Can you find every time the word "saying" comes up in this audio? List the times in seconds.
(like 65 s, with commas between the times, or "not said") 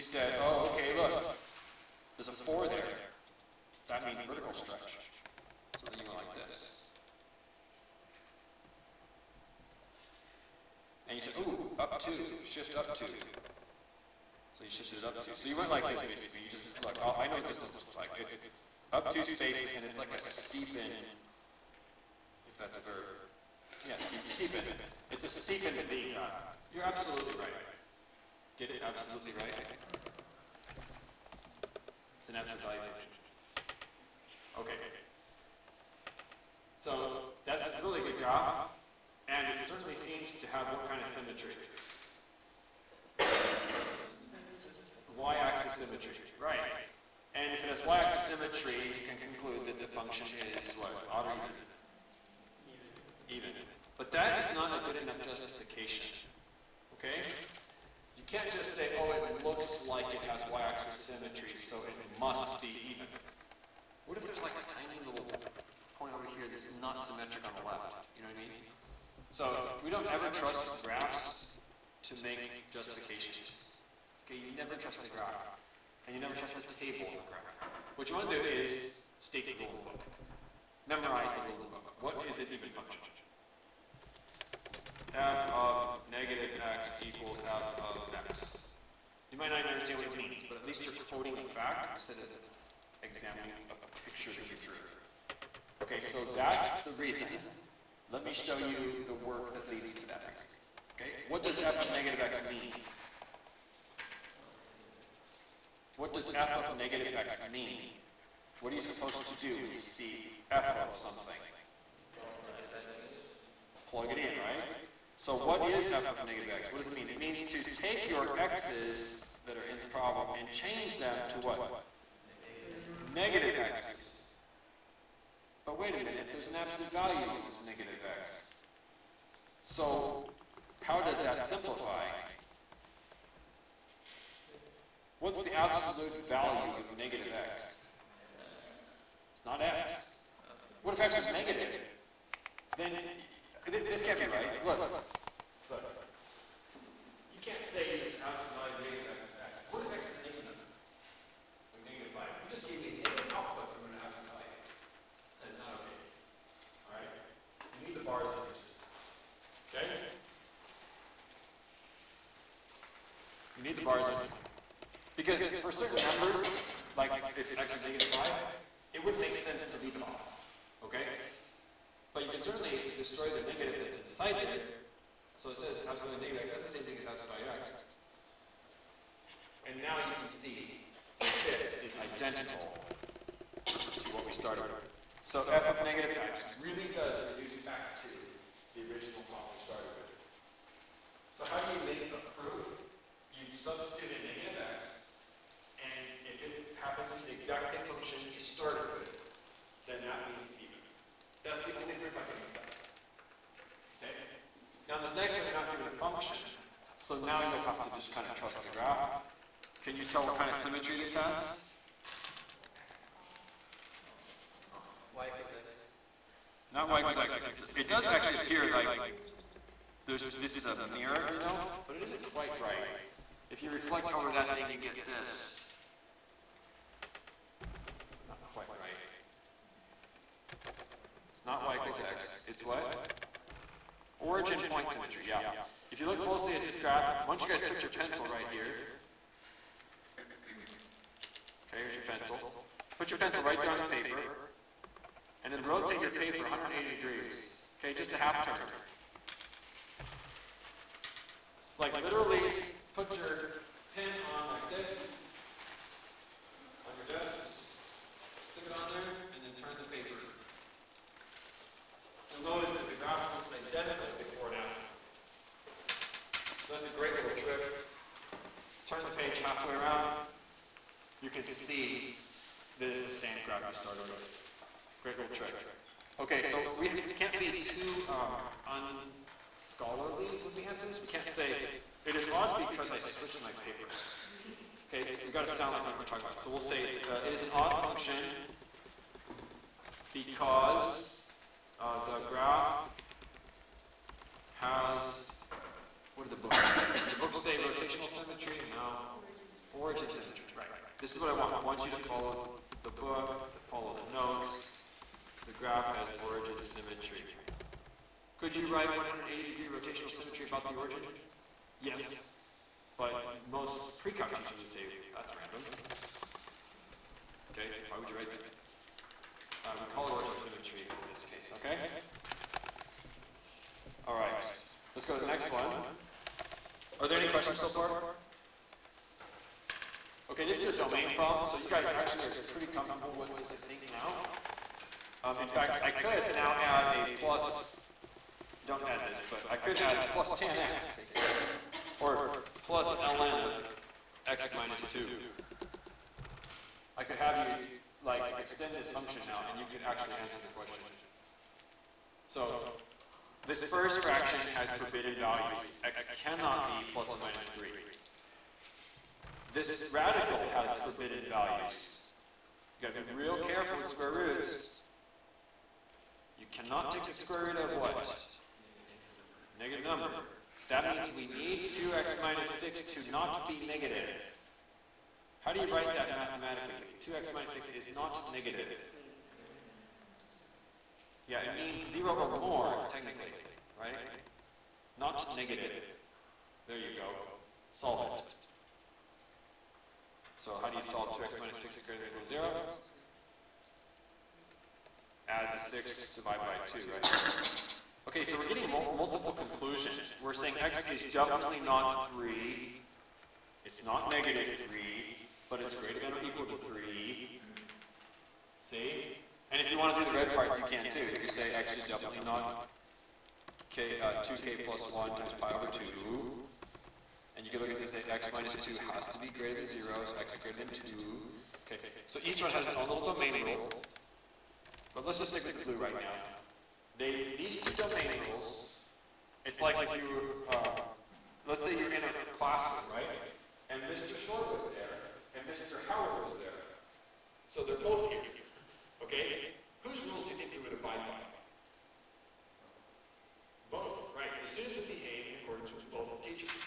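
400 s.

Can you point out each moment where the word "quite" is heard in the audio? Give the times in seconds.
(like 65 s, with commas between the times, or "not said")
222 s, 228 s.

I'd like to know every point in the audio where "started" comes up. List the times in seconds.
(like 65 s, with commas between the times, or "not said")
184 s, 189 s, 198 s, 273 s.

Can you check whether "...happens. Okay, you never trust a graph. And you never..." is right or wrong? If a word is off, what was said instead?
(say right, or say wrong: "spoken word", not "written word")
wrong: "justifications", not "happens".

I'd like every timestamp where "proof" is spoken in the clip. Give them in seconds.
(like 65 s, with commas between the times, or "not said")
192 s, 201 s.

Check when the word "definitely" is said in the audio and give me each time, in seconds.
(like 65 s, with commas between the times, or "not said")
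401 s, 411 s.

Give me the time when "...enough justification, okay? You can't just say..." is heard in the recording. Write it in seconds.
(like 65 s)
54 s.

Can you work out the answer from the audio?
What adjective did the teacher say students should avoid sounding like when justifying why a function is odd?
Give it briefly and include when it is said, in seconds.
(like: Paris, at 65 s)
unscholarly, at 279 s.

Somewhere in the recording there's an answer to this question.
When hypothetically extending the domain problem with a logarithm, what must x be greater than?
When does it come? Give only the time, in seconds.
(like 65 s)
420 s.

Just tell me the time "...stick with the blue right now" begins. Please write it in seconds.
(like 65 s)
425 s.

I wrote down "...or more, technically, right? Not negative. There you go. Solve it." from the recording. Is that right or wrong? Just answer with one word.
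right.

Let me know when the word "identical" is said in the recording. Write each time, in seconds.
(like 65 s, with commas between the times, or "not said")
182 s, 263 s.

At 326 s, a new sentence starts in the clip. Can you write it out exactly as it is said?
Are there any questions so far?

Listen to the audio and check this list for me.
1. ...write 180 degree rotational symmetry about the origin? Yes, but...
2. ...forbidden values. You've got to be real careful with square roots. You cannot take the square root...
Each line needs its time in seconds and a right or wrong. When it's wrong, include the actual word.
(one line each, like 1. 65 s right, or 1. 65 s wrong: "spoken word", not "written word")
1. 308 s right
2. 360 s right.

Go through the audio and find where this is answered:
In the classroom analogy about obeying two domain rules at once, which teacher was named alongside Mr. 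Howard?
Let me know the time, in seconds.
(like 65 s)
433 s.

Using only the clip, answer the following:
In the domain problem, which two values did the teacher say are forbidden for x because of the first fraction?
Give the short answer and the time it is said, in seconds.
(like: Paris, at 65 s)
plus or minus 3, at 356 s.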